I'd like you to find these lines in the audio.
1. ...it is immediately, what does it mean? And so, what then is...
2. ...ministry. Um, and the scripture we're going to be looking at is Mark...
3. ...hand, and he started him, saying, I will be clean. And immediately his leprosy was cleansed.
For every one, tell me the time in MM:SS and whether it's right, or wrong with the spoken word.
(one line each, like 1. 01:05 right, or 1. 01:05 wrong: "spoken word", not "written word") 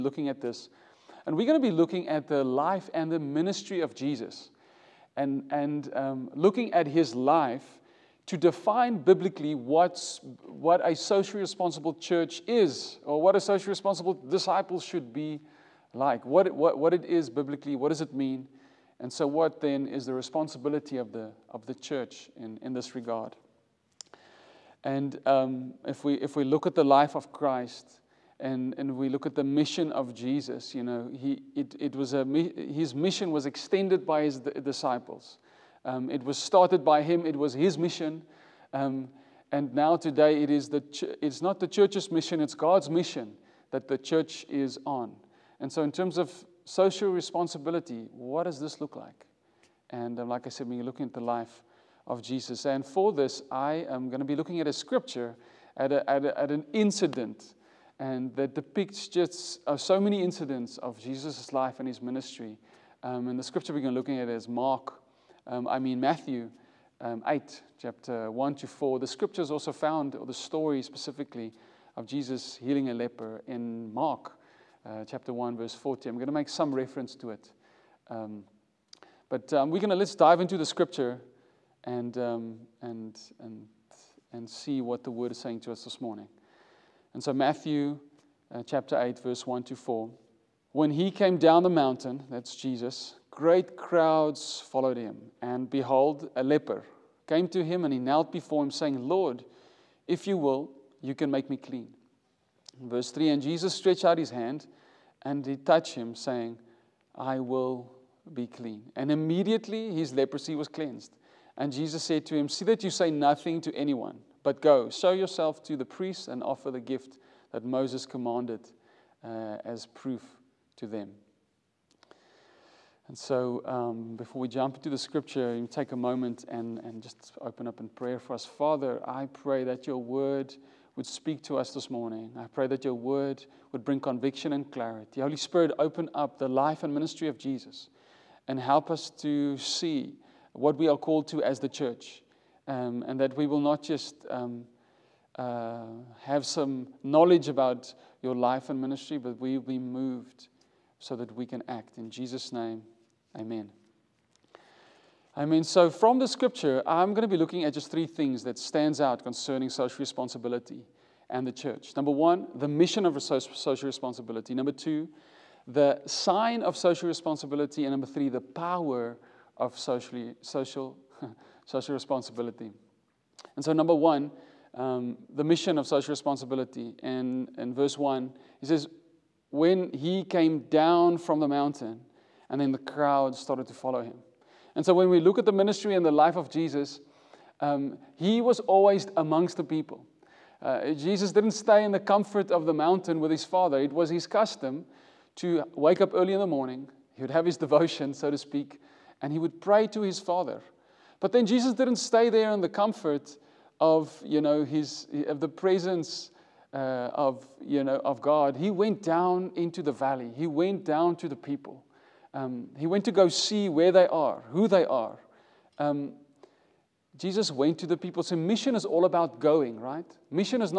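1. 00:16 wrong: "biblically", not "immediately"
2. 01:02 right
3. 01:44 wrong: "touched", not "started".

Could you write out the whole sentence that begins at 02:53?
And so, number one, um, the mission of social responsibility.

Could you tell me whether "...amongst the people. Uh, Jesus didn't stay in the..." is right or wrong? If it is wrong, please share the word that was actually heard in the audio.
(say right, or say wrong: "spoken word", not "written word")
right.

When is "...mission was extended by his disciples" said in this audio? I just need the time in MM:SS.
00:32.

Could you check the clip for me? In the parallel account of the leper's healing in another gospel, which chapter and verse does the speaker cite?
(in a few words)
Mark 1:40.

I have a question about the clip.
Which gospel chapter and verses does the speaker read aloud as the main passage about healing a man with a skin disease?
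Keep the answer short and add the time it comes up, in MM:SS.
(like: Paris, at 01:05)
Matthew 8:1-4, at 01:27.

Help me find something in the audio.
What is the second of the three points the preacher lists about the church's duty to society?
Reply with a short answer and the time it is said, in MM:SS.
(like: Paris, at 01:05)
The sign, at 02:45.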